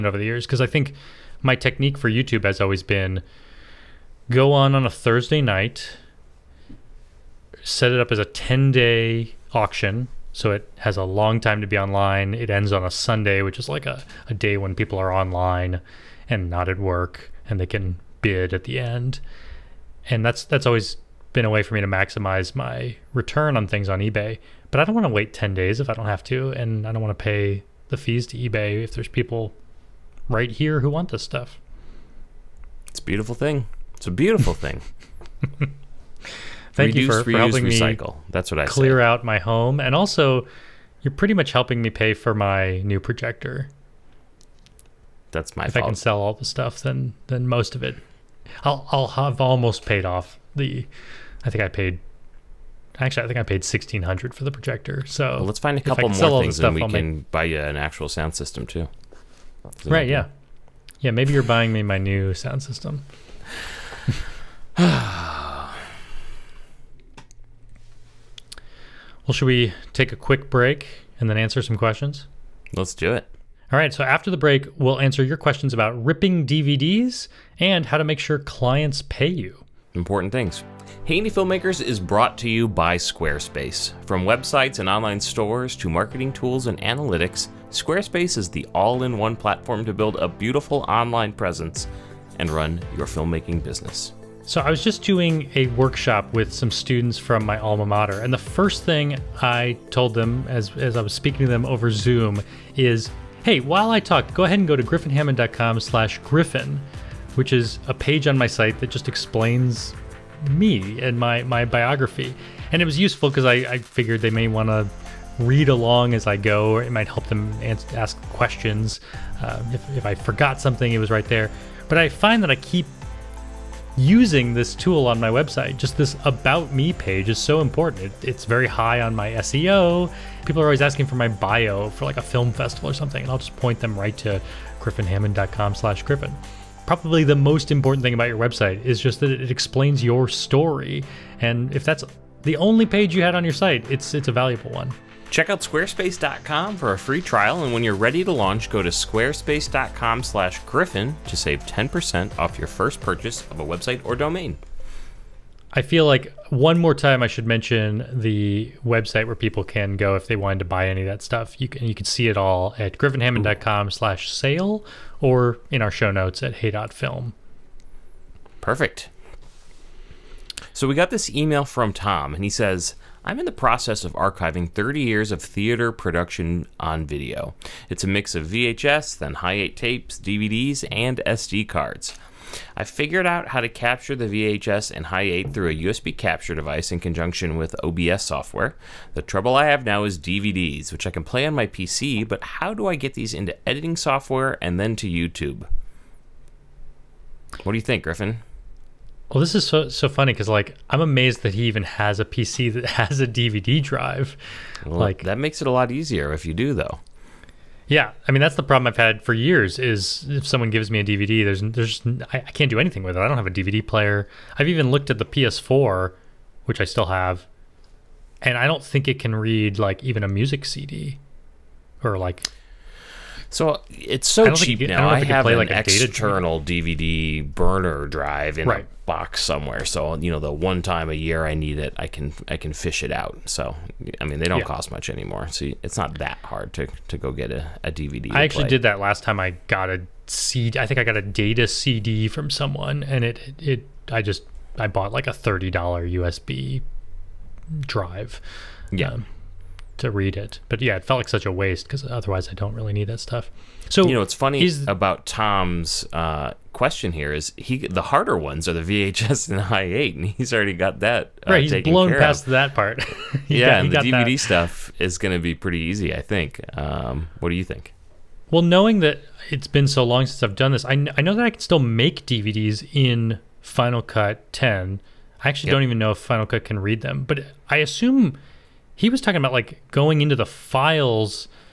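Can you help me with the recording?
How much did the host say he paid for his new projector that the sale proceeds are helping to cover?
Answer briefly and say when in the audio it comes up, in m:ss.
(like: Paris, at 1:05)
$1,600, at 0:53.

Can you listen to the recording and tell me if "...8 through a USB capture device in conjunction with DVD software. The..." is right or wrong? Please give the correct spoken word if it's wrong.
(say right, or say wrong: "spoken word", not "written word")
wrong: "OBS", not "DVD".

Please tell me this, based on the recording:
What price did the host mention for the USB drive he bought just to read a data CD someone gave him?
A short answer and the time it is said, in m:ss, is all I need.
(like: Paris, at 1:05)
$30, at 4:05.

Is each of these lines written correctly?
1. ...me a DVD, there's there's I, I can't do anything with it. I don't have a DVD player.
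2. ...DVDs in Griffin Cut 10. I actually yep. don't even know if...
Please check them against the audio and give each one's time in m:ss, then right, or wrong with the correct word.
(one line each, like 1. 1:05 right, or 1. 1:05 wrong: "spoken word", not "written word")
1. 3:30 right
2. 4:32 wrong: "Final", not "Griffin".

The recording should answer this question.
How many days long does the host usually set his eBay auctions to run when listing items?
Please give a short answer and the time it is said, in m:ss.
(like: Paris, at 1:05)
10, at 0:08.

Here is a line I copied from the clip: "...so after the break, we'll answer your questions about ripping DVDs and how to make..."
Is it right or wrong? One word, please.
right.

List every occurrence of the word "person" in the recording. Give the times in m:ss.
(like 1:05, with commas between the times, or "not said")
not said.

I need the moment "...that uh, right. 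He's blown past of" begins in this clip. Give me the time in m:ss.
4:21.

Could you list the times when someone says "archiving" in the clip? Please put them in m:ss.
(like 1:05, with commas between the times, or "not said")
2:54.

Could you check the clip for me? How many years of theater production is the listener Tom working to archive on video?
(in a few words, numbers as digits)
30.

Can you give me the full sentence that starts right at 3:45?
I, I have an like external DVD burner drive in right.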